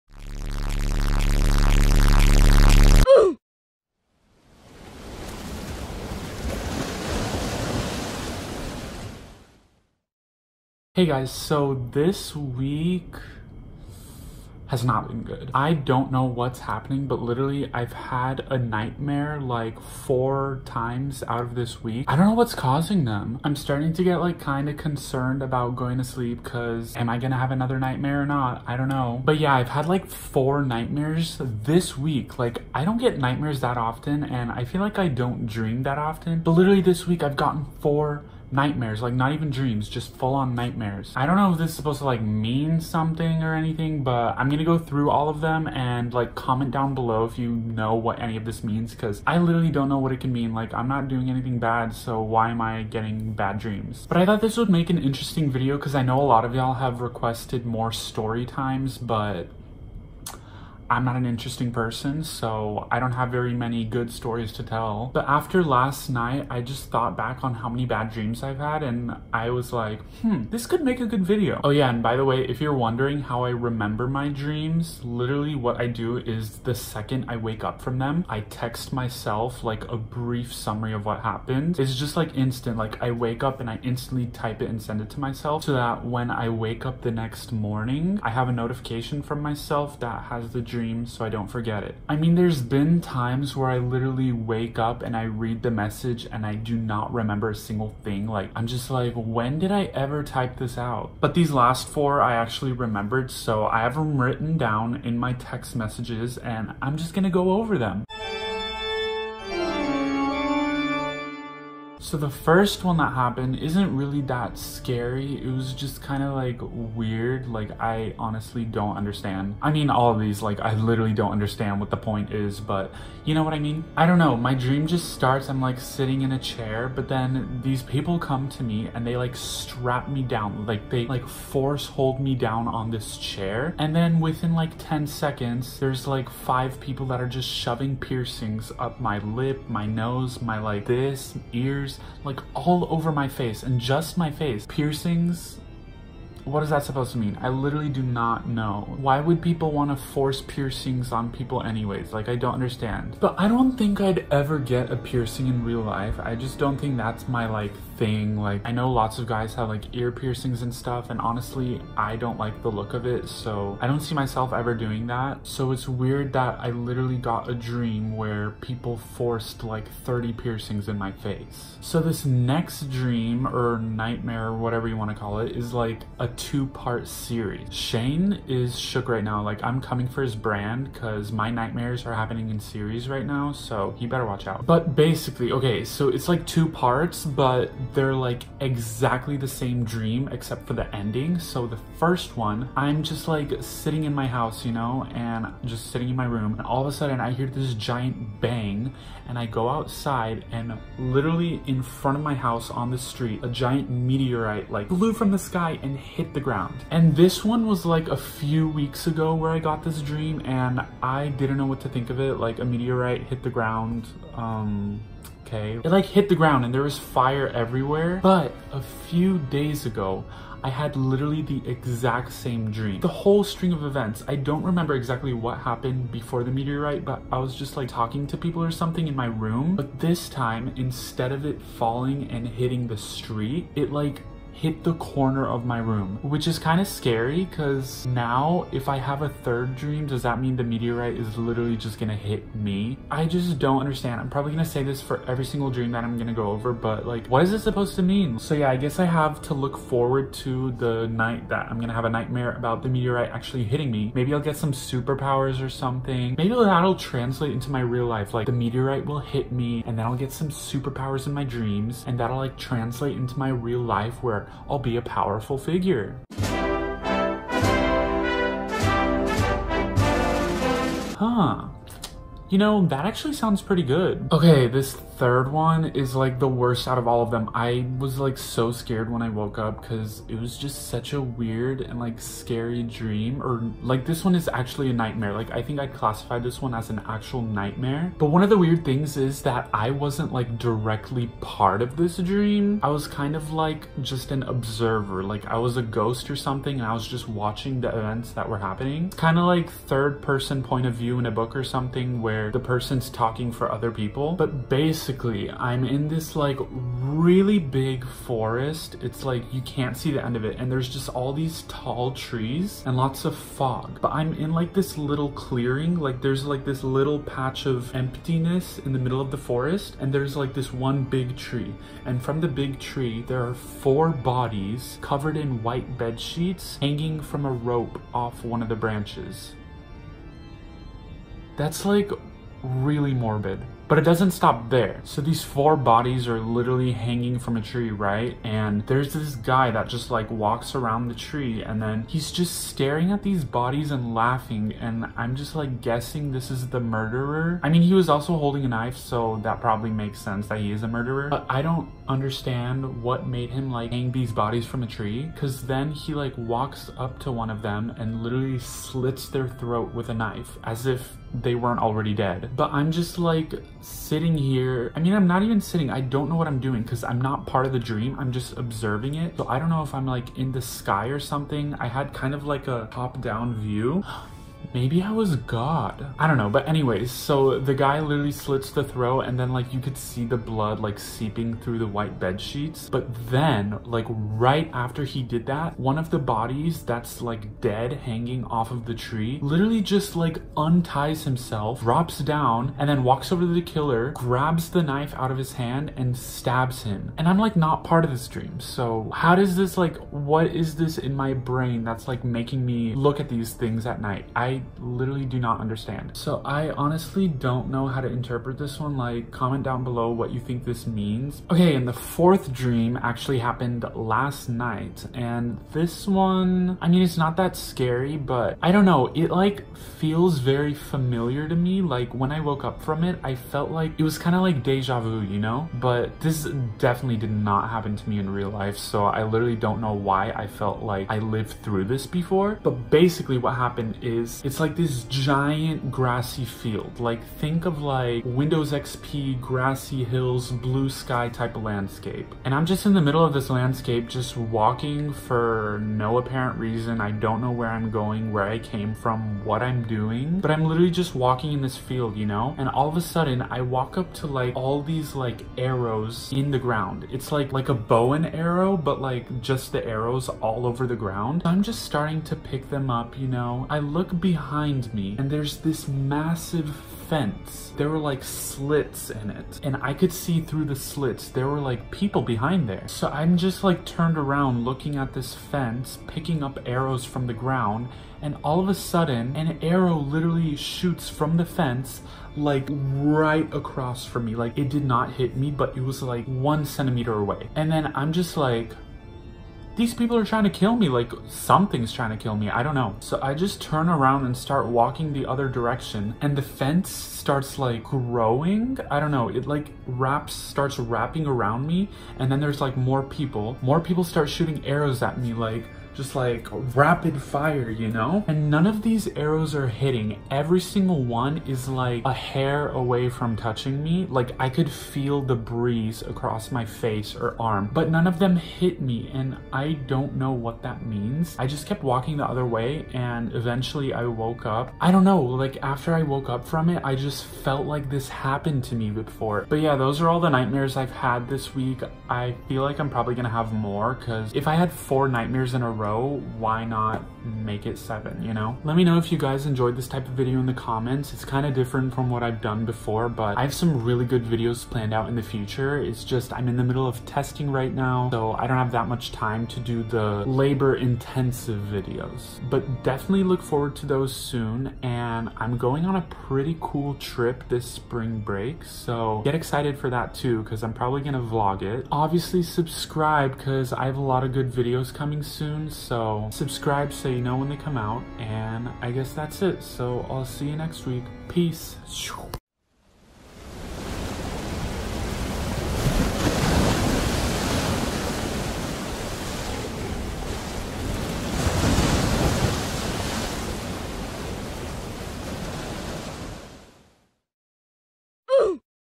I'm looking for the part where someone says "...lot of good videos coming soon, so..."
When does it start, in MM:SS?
09:24.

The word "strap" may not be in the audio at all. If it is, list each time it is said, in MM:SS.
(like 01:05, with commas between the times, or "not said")
02:09.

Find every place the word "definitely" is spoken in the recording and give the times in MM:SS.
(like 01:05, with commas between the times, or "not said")
07:06, 09:12.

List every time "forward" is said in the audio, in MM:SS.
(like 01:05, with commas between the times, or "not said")
04:09, 09:13.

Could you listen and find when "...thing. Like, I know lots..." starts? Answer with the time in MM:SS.
02:37.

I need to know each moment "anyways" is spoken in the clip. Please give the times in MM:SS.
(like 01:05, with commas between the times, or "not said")
02:31, 06:16.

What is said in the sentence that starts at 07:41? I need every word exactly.
I'm just starting to pick them up, you know?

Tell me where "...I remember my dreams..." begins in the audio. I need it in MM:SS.
01:13.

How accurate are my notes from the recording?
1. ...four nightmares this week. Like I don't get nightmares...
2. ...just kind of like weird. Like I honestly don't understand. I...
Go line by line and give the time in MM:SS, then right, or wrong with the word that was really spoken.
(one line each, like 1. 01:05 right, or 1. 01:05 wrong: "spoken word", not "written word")
1. 00:30 right
2. 01:55 right.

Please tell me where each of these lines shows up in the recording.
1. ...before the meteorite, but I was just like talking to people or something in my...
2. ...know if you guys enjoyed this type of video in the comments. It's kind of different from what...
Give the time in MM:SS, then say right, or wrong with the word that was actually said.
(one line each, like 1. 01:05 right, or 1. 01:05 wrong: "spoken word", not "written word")
1. 03:46 right
2. 08:58 right.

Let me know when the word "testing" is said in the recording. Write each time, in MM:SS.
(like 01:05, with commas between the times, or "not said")
09:07.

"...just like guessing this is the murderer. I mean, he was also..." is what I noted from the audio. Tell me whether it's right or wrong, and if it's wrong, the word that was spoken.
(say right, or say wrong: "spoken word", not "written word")
right.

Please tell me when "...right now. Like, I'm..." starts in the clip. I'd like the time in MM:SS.
02:59.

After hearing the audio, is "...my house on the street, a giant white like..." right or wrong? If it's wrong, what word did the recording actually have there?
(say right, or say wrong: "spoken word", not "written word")
wrong: "meteorite", not "white".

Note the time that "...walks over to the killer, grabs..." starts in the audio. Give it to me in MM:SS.
06:33.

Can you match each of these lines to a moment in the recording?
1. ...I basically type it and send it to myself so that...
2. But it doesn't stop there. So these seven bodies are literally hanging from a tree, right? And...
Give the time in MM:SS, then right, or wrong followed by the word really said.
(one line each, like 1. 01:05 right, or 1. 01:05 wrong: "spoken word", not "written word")
1. 01:23 wrong: "instantly", not "basically"
2. 05:33 wrong: "four", not "seven".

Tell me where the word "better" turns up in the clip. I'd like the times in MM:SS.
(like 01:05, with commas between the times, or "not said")
03:04.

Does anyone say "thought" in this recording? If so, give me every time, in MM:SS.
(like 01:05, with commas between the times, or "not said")
00:54, 01:06.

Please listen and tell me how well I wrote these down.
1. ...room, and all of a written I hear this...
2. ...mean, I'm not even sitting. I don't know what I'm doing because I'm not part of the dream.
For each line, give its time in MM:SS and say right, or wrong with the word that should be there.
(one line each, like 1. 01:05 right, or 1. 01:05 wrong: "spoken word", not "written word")
1. 03:16 wrong: "sudden", not "written"
2. 06:04 right.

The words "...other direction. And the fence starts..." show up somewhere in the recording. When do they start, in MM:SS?
08:15.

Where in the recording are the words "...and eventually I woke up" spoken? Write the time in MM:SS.
08:42.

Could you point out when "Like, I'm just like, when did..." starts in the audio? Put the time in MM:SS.
01:38.